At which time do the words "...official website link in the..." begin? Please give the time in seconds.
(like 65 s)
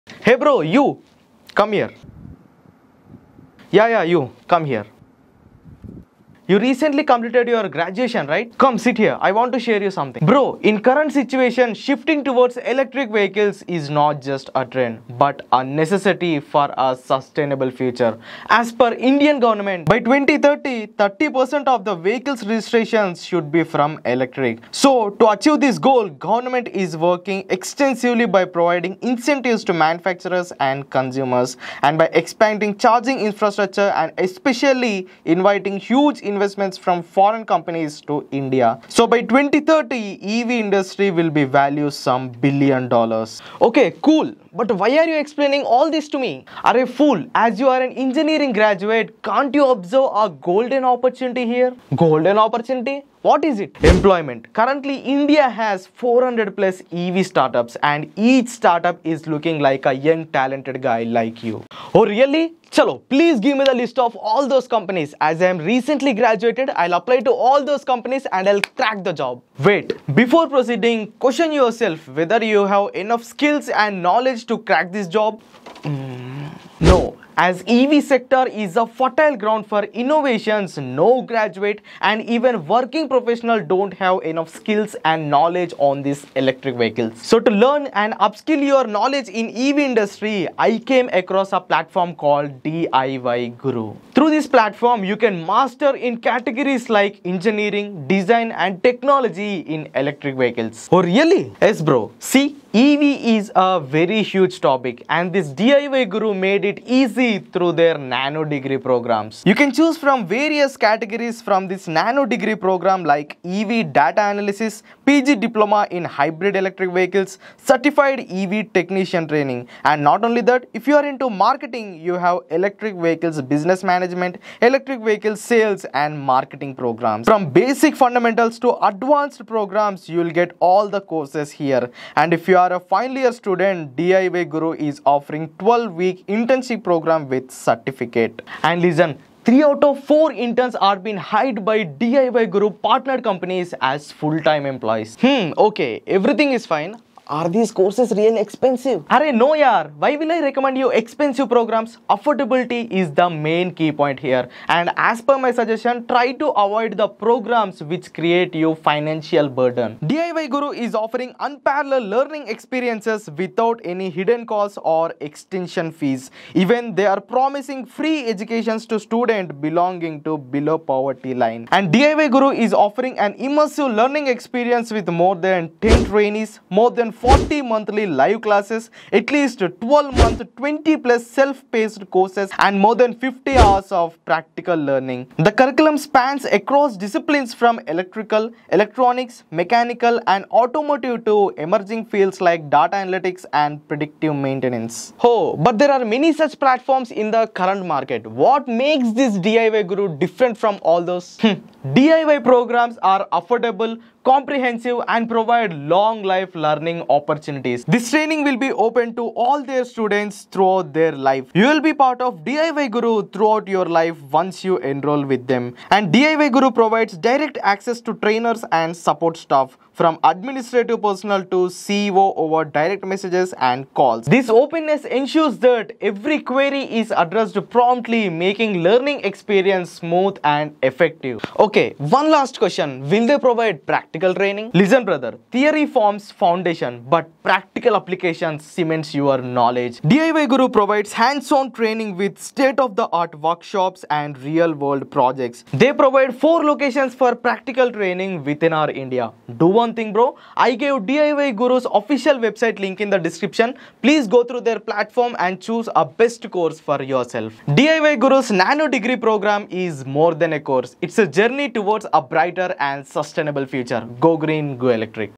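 251 s.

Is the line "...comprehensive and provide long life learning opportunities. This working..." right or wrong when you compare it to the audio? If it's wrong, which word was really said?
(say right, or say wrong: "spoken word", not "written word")
wrong: "training", not "working".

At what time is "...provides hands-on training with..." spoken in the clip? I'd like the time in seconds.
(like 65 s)
240 s.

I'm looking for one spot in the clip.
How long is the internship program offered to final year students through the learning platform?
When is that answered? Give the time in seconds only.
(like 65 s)
135 s.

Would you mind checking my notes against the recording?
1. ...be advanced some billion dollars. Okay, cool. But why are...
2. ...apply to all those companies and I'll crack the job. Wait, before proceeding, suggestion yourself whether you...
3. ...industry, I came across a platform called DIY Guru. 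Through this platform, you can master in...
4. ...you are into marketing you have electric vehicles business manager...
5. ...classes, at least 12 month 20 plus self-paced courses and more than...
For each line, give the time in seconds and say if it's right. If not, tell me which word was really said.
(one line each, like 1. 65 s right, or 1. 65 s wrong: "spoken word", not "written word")
1. 41 s wrong: "valued", not "advanced"
2. 66 s wrong: "question", not "suggestion"
3. 89 s right
4. 120 s right
5. 178 s right.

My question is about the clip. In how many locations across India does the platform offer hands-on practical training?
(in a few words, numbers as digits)
4.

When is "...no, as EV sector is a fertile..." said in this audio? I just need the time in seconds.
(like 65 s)
76 s.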